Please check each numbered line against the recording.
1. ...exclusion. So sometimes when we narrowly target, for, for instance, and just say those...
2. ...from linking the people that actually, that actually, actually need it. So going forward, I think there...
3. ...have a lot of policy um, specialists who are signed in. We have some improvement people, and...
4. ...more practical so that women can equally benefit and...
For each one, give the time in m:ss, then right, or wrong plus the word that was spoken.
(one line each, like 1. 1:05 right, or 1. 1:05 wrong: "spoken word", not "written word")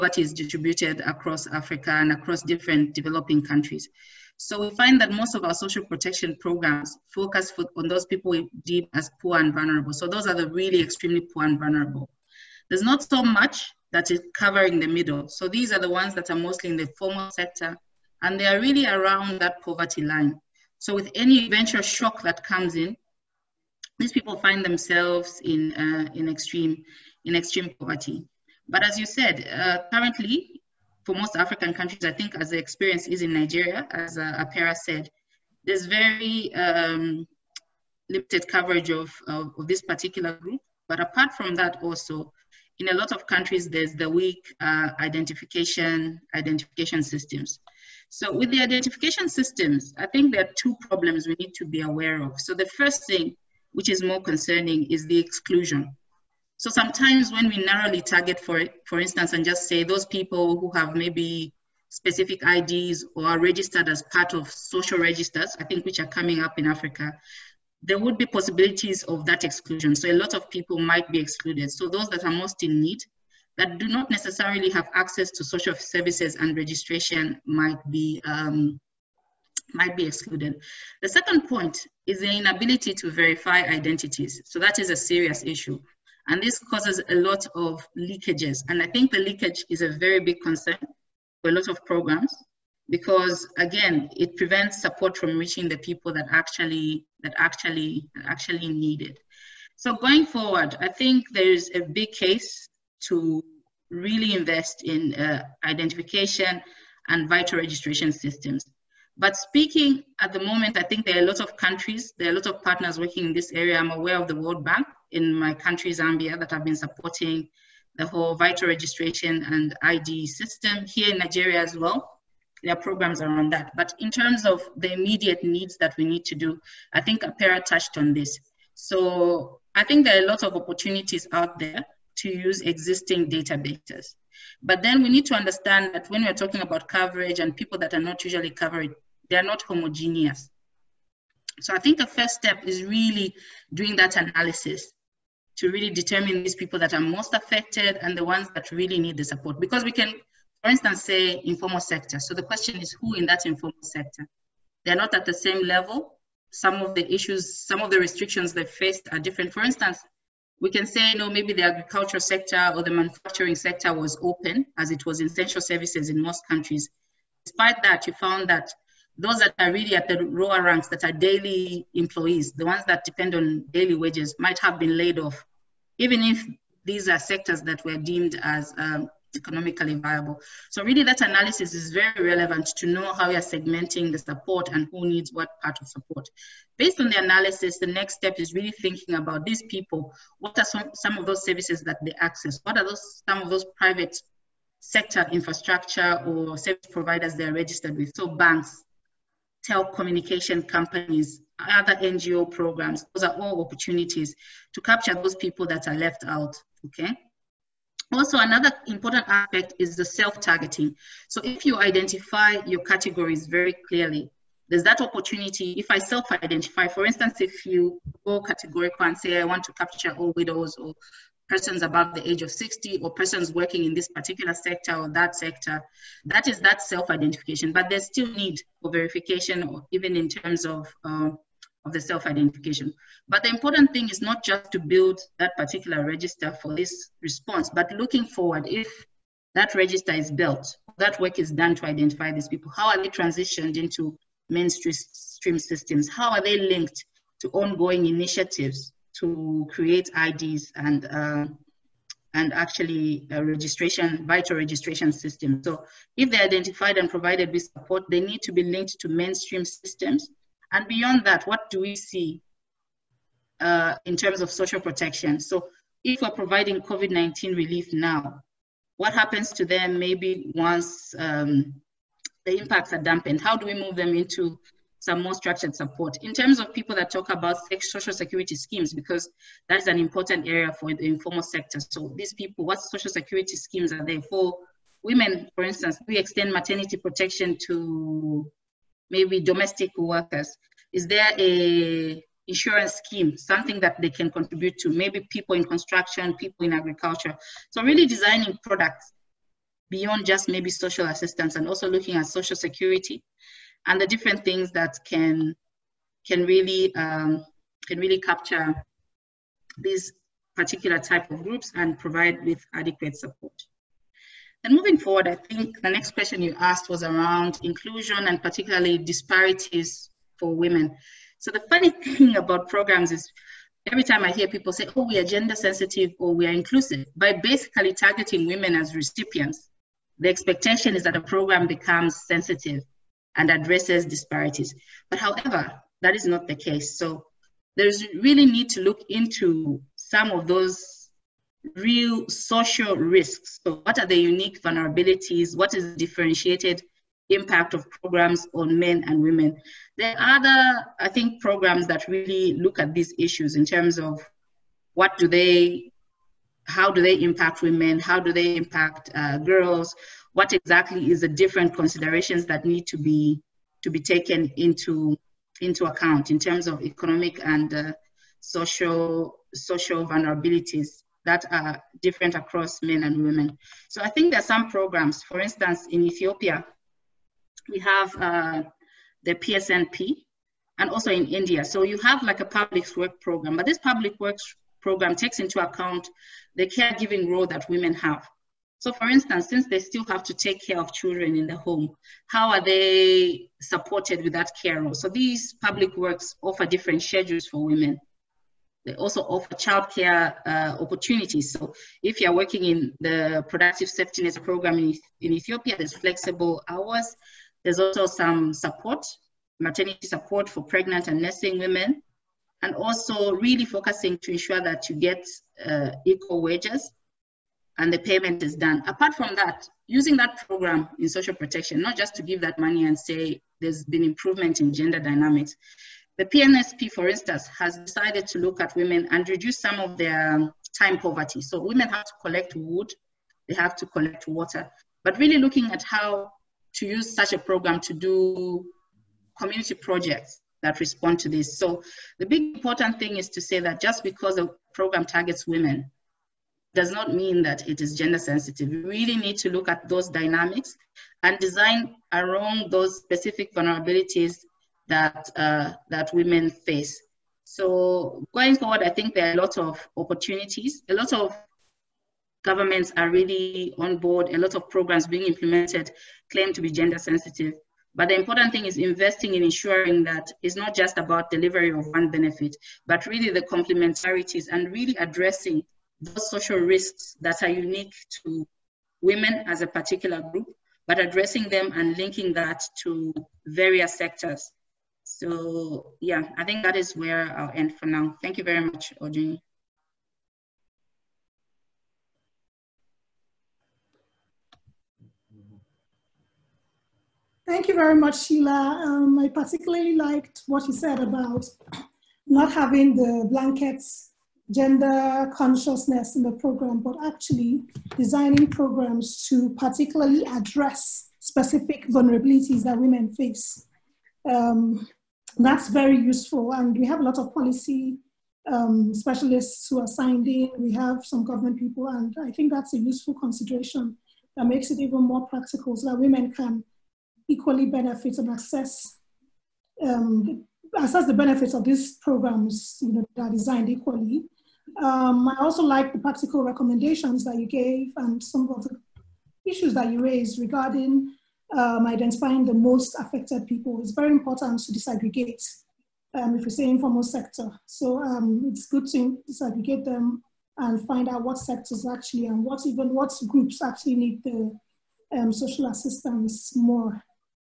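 1. 0:55 right
2. 1:35 wrong: "reaching", not "linking"
3. 8:36 wrong: "government", not "improvement"
4. 8:45 right.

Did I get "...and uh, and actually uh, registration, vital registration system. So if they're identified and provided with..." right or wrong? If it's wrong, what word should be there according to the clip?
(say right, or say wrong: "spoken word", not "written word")
right.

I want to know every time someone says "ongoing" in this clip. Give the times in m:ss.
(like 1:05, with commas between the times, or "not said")
4:07.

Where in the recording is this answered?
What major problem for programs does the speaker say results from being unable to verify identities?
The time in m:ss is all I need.
1:27.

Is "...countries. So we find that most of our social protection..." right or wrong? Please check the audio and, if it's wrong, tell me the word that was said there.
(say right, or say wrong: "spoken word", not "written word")
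right.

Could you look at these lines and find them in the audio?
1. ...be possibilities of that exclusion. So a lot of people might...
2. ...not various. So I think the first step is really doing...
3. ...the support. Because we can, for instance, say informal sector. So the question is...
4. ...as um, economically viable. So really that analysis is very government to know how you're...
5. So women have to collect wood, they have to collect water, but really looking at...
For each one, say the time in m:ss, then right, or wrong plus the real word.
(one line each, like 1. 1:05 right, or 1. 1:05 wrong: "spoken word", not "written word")
1. 1:08 right
2. 2:19 wrong: "homogeneous", not "various"
3. 2:29 right
4. 2:58 wrong: "relevant", not "government"
5. 7:11 right.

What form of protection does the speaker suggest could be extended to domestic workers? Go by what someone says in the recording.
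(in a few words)
maternity protection.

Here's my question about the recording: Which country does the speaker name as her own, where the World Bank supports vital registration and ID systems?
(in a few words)
Zambia.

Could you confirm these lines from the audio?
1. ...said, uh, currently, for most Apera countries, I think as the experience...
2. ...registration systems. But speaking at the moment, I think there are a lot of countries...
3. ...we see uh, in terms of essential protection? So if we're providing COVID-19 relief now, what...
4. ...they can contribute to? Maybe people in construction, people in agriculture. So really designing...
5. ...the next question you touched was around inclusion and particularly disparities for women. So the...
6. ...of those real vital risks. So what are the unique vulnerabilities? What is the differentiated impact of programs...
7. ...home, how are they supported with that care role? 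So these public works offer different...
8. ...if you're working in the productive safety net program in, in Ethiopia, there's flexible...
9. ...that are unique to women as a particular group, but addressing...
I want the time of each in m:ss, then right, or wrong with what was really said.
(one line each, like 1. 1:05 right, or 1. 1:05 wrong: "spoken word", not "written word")
1. 0:29 wrong: "African", not "Apera"
2. 1:47 right
3. 4:21 wrong: "social", not "essential"
4. 4:54 right
5. 5:15 wrong: "asked", not "touched"
6. 5:40 wrong: "social", not "vital"
7. 6:31 right
8. 6:42 right
9. 7:57 right.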